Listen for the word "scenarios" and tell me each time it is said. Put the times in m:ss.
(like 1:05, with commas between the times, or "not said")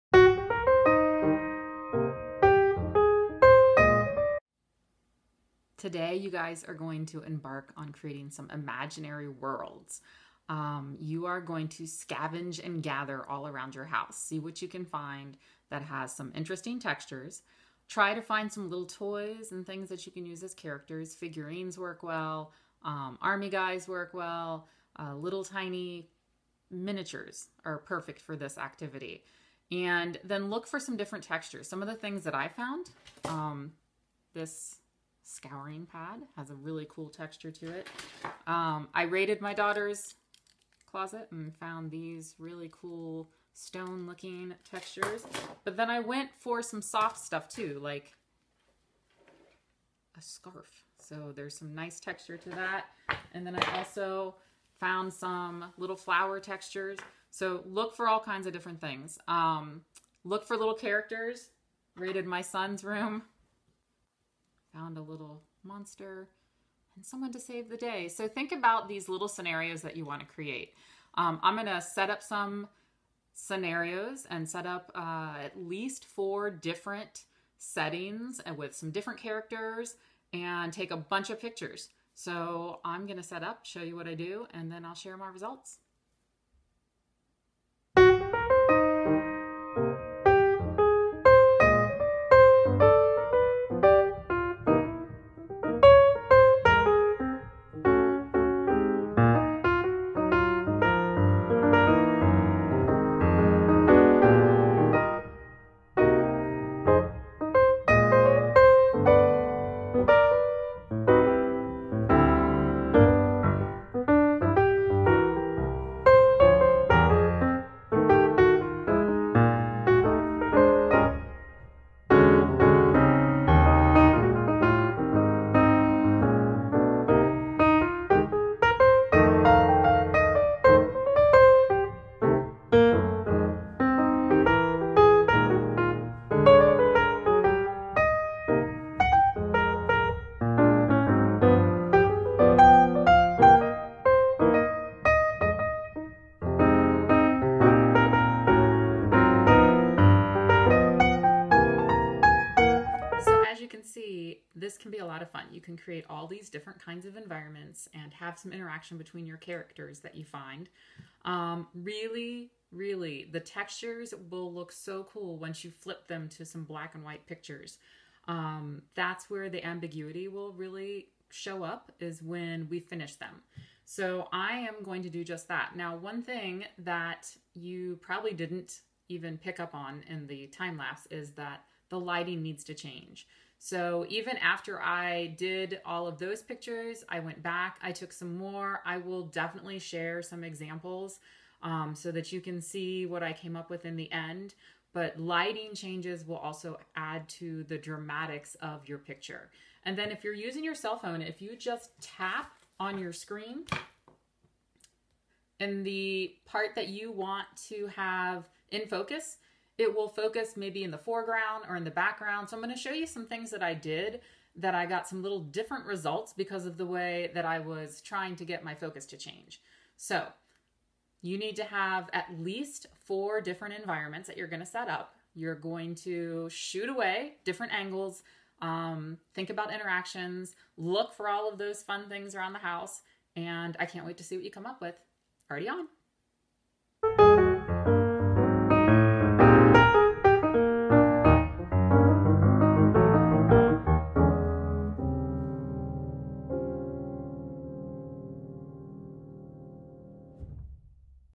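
1:09, 1:13.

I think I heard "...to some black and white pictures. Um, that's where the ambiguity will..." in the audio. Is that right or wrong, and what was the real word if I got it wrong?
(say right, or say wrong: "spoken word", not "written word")
right.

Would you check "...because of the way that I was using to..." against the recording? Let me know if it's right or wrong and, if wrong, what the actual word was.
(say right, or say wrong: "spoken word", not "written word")
wrong: "trying", not "using".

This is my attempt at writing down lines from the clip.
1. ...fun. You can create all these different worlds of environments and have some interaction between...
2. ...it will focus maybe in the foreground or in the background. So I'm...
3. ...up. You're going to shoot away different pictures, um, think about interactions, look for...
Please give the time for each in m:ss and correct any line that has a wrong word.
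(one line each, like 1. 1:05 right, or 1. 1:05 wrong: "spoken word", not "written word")
1. 2:35 wrong: "kinds", not "worlds"
2. 3:29 right
3. 3:44 wrong: "angles", not "pictures".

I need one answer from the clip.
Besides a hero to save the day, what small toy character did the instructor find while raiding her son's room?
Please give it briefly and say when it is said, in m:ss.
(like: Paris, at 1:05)
A little monster, at 1:05.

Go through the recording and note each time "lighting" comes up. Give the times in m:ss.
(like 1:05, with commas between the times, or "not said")
3:01, 3:15.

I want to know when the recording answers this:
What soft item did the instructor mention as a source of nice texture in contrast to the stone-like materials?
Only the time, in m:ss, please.
0:50.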